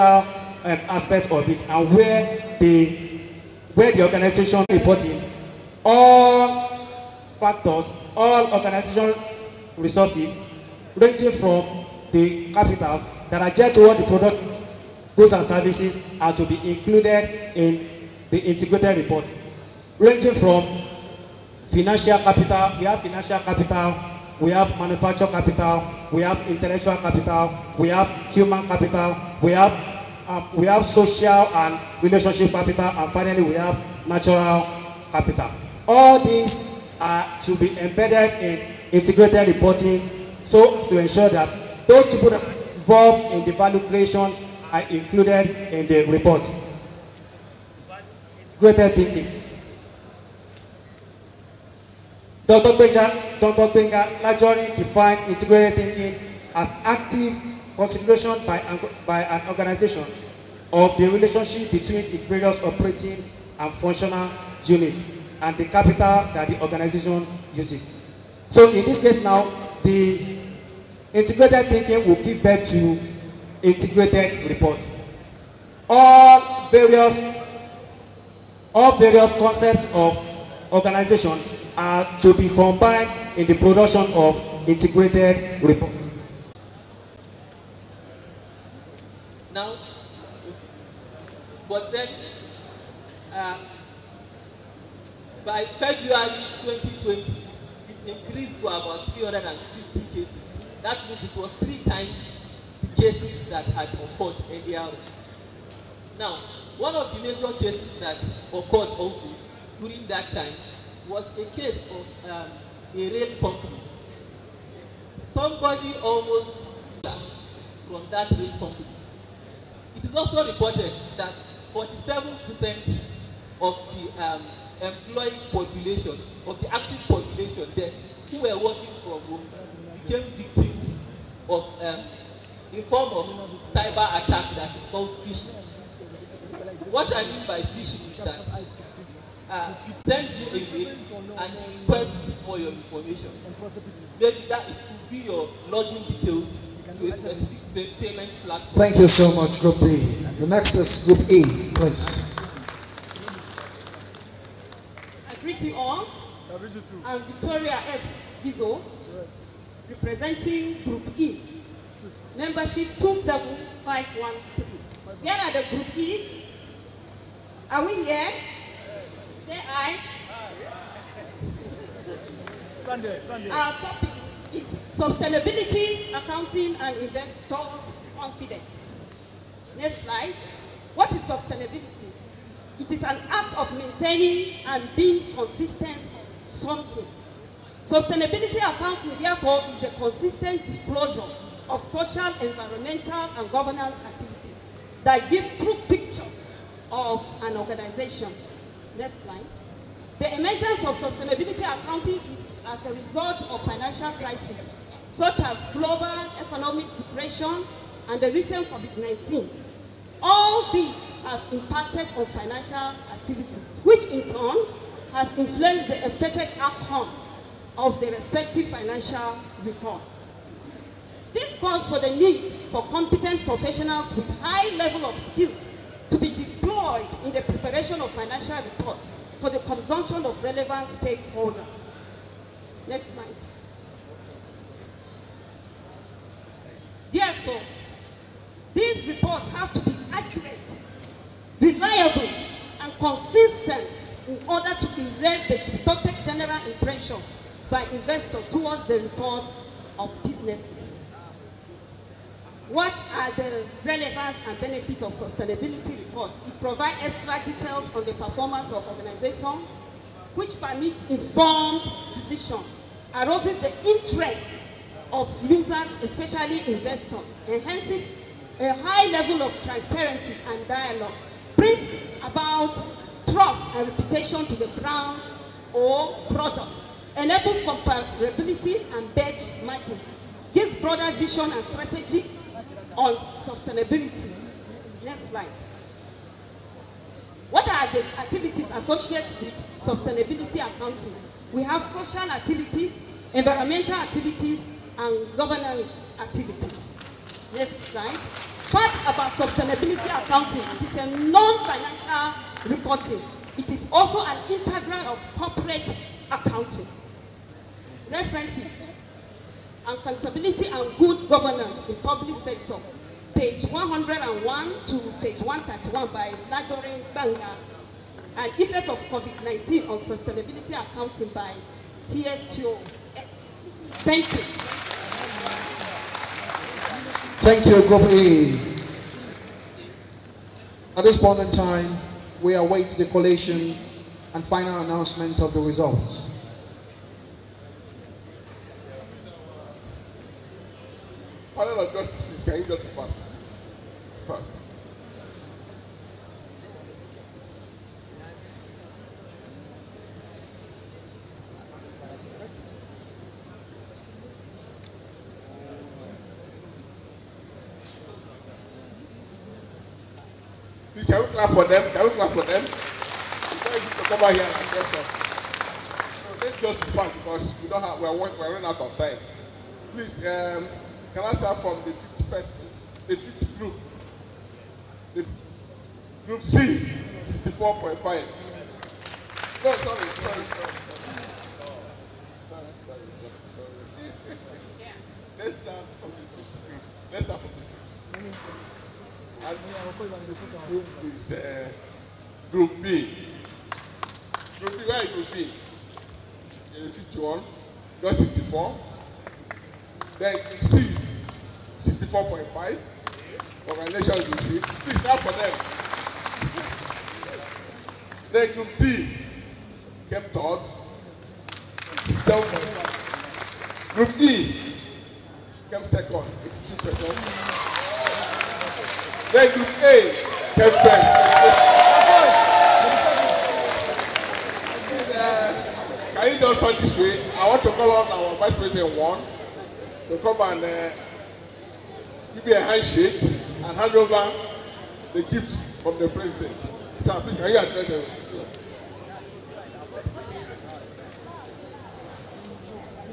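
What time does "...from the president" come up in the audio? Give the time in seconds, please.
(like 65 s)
435 s.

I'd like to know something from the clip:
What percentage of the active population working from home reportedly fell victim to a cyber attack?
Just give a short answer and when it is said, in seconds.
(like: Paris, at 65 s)
47%, at 121 s.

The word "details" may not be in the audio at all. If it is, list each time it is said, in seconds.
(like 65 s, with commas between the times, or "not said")
146 s, 257 s.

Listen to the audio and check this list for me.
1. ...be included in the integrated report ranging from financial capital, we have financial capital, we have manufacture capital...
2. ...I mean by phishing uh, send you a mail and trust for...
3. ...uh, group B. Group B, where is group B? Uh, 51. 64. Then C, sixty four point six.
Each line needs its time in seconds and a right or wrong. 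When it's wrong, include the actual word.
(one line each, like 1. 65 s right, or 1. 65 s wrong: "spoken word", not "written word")
1. 16 s right
2. 137 s wrong: "request", not "trust"
3. 391 s wrong: "five", not "six".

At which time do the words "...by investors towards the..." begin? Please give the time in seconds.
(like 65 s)
247 s.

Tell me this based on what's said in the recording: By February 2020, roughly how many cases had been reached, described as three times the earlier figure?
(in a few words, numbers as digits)
350.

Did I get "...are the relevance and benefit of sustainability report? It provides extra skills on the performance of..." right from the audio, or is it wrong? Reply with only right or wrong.
wrong.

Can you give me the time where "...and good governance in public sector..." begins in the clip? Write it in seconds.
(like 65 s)
310 s.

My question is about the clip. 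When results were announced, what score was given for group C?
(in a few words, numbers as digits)
64.5.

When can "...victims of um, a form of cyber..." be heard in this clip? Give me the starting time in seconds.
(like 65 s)
130 s.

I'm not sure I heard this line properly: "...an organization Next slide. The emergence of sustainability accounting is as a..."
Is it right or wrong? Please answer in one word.
right.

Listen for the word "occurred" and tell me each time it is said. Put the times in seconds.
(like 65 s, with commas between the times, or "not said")
103 s, 108 s.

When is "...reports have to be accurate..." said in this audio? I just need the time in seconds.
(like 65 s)
239 s.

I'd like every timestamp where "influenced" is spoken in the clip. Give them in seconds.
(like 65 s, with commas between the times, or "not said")
215 s.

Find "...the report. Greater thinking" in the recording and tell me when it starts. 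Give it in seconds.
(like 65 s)
45 s.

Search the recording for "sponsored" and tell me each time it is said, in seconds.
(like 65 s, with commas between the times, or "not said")
not said.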